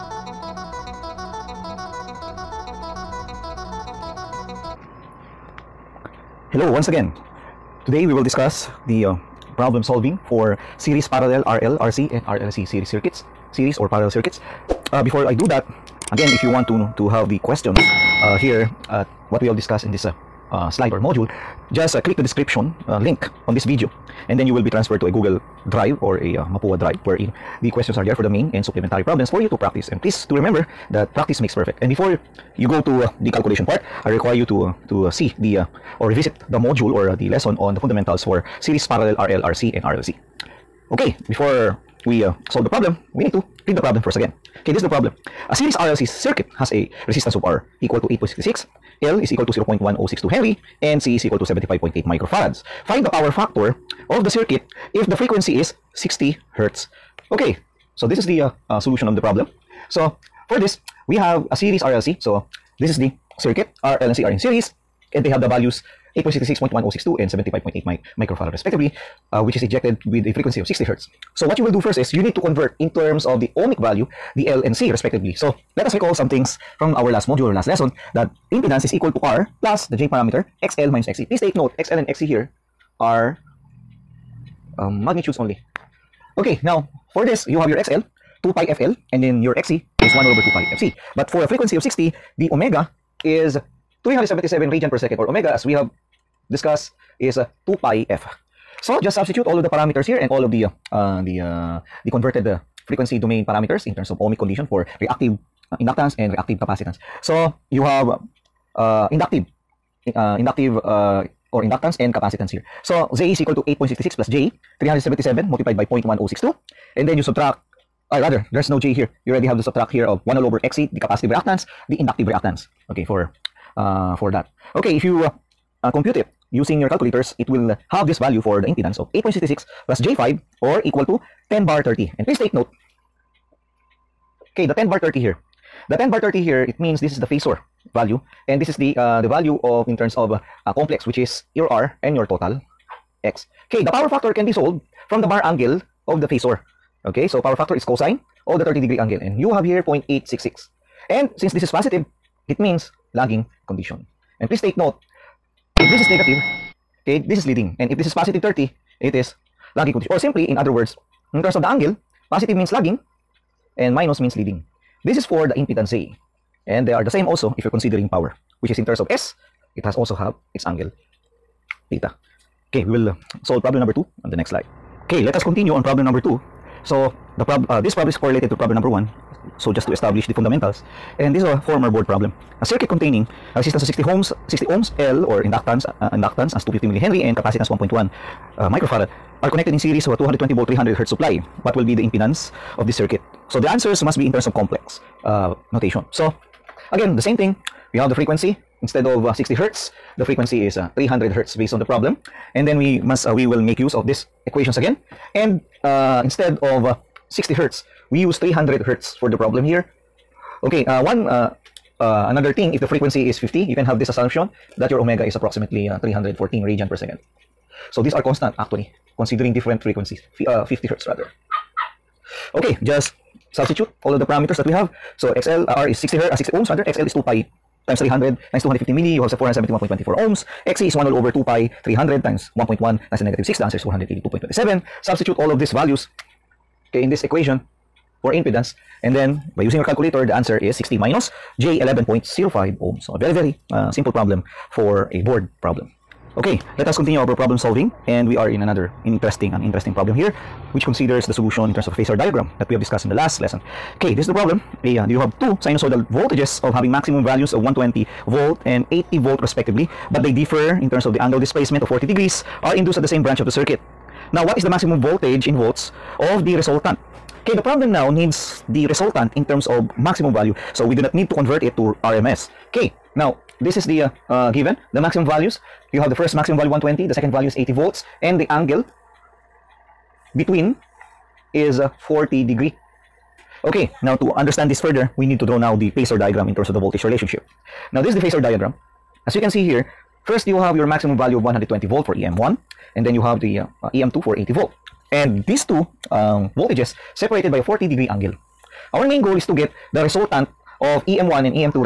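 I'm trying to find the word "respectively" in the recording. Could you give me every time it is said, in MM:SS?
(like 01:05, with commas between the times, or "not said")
01:08, 01:14, 04:19.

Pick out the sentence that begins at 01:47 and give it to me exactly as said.
So you have uh, inductive uh, inductive uh, or inductance and capacitance here.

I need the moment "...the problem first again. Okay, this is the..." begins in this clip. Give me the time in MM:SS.
00:43.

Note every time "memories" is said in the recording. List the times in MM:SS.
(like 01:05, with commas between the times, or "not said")
not said.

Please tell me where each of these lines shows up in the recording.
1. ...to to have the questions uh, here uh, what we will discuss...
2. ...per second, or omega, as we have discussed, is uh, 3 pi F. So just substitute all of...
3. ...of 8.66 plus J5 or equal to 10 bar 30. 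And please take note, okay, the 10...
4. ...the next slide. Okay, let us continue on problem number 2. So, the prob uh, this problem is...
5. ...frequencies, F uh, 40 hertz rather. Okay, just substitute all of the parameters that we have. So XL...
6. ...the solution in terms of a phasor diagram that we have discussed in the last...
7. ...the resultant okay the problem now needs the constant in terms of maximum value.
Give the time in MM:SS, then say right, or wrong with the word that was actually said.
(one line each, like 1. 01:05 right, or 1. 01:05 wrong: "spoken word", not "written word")
1. 00:16 right
2. 01:34 wrong: "2", not "3"
3. 02:08 right
4. 02:54 right
5. 03:39 wrong: "50", not "40"
6. 04:11 right
7. 04:26 wrong: "resultant", not "constant".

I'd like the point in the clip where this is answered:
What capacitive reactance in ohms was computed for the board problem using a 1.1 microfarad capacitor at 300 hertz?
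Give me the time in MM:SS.
03:53.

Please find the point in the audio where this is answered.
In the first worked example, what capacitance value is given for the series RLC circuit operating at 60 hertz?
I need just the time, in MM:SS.
00:51.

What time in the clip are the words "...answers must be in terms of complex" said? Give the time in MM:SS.
03:13.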